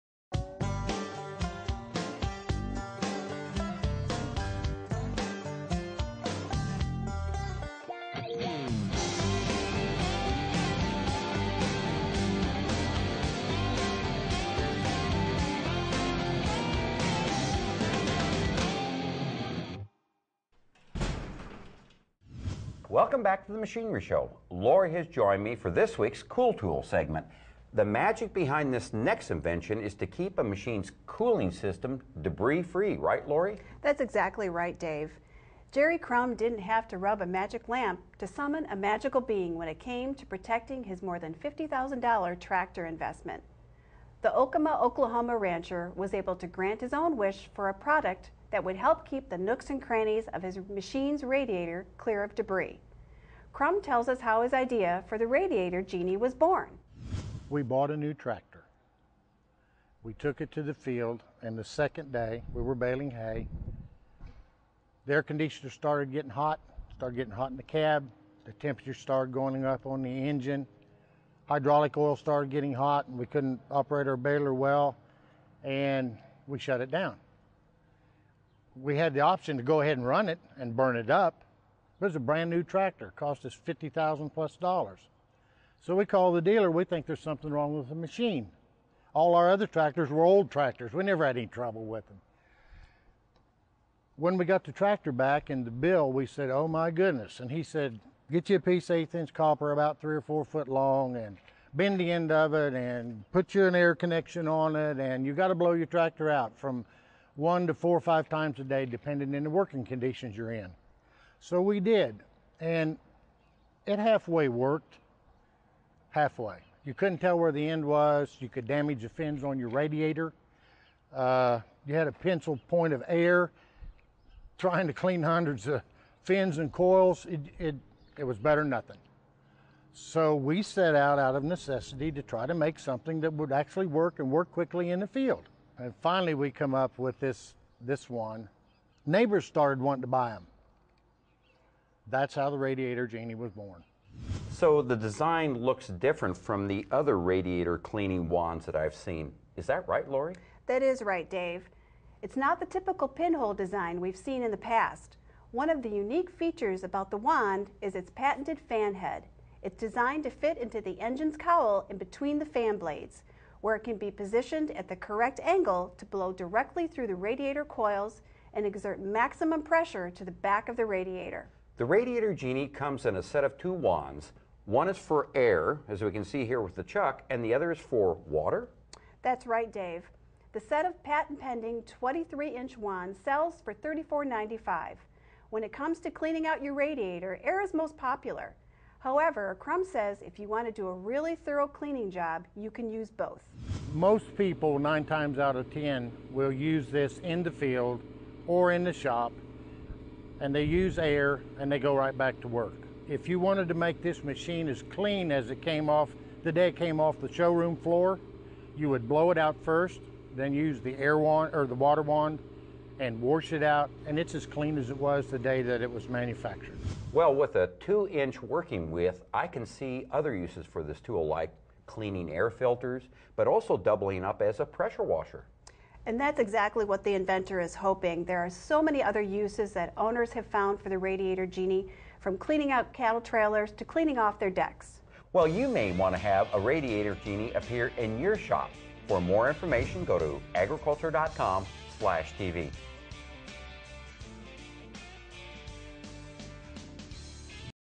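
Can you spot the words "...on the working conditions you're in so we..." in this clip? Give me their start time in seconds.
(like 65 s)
109 s.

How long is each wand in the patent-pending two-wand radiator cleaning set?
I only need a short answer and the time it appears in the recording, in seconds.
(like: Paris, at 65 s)
23 inches, at 182 s.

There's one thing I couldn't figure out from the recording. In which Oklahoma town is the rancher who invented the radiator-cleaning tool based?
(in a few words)
Okemah.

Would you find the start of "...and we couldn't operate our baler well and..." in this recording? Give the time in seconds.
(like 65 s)
73 s.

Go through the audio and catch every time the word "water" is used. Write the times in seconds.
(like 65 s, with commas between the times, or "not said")
178 s, 211 s.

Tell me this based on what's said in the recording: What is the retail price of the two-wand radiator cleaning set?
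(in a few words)
$34.95.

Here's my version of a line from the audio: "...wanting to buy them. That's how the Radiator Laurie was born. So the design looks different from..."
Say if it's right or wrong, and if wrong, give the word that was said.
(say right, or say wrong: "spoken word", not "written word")
wrong: "Genie", not "Laurie".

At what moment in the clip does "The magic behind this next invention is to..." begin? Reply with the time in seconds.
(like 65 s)
27 s.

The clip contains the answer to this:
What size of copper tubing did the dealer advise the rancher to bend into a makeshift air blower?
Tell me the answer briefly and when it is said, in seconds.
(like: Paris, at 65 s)
eighth inch, at 98 s.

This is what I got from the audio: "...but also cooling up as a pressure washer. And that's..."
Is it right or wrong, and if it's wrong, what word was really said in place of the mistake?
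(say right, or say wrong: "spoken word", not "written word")
wrong: "doubling", not "cooling".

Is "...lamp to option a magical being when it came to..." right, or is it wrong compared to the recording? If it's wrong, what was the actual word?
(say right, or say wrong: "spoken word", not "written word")
wrong: "summon", not "option".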